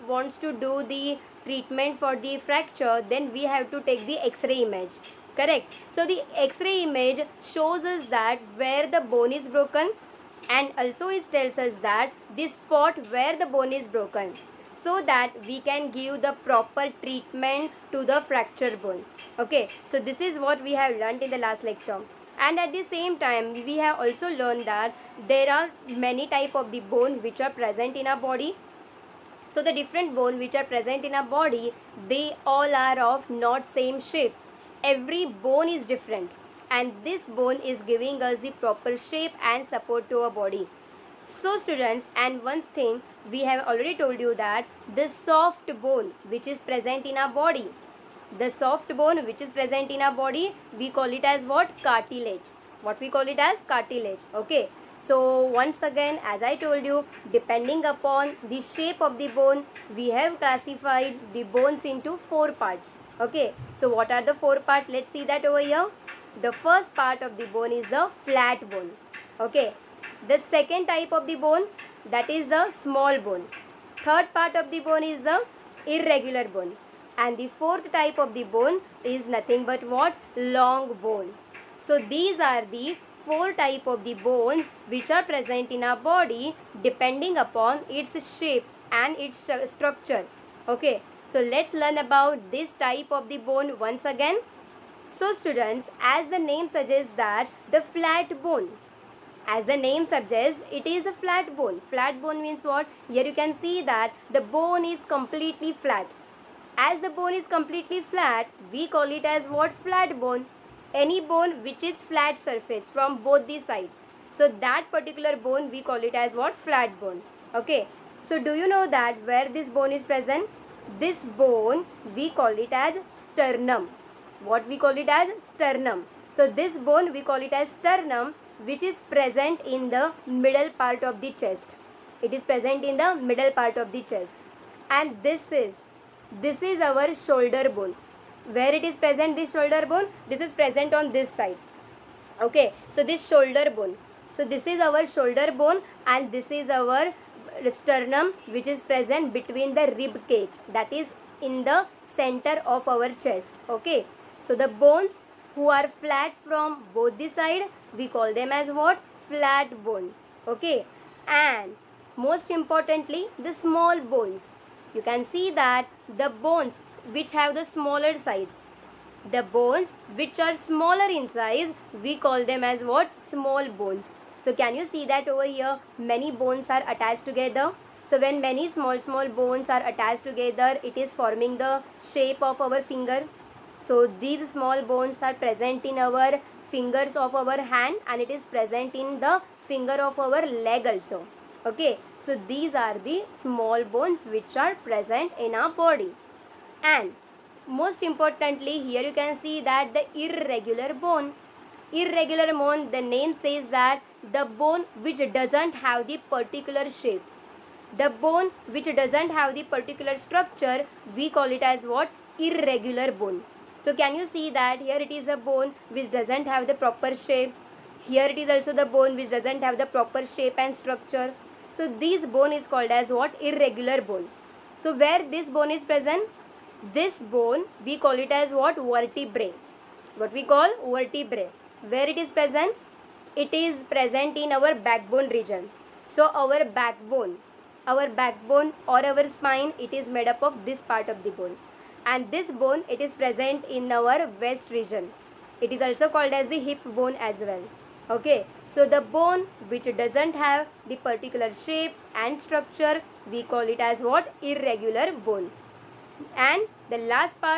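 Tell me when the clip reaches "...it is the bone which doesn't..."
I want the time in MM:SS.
03:35.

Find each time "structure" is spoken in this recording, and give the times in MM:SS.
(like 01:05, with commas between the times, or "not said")
01:29, 03:30, 03:40, 04:12.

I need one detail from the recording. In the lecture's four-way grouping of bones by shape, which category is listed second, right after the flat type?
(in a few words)
Small bone.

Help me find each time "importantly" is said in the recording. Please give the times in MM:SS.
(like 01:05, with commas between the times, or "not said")
02:42, 03:18.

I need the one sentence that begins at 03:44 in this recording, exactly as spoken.
So where this bone is present?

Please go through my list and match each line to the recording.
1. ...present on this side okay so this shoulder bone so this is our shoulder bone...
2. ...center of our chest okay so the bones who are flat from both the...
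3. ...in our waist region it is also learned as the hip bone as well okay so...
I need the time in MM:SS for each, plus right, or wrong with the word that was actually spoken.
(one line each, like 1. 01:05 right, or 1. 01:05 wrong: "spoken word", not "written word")
1. 02:20 right
2. 02:32 right
3. 04:03 wrong: "called", not "learned".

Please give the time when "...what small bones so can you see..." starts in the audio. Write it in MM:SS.
02:52.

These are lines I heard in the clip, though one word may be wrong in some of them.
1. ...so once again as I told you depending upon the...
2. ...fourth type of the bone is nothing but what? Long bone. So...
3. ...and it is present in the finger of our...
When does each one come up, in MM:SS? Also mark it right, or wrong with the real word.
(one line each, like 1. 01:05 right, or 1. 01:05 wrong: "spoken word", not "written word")
1. 00:55 right
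2. 01:17 right
3. 03:08 right.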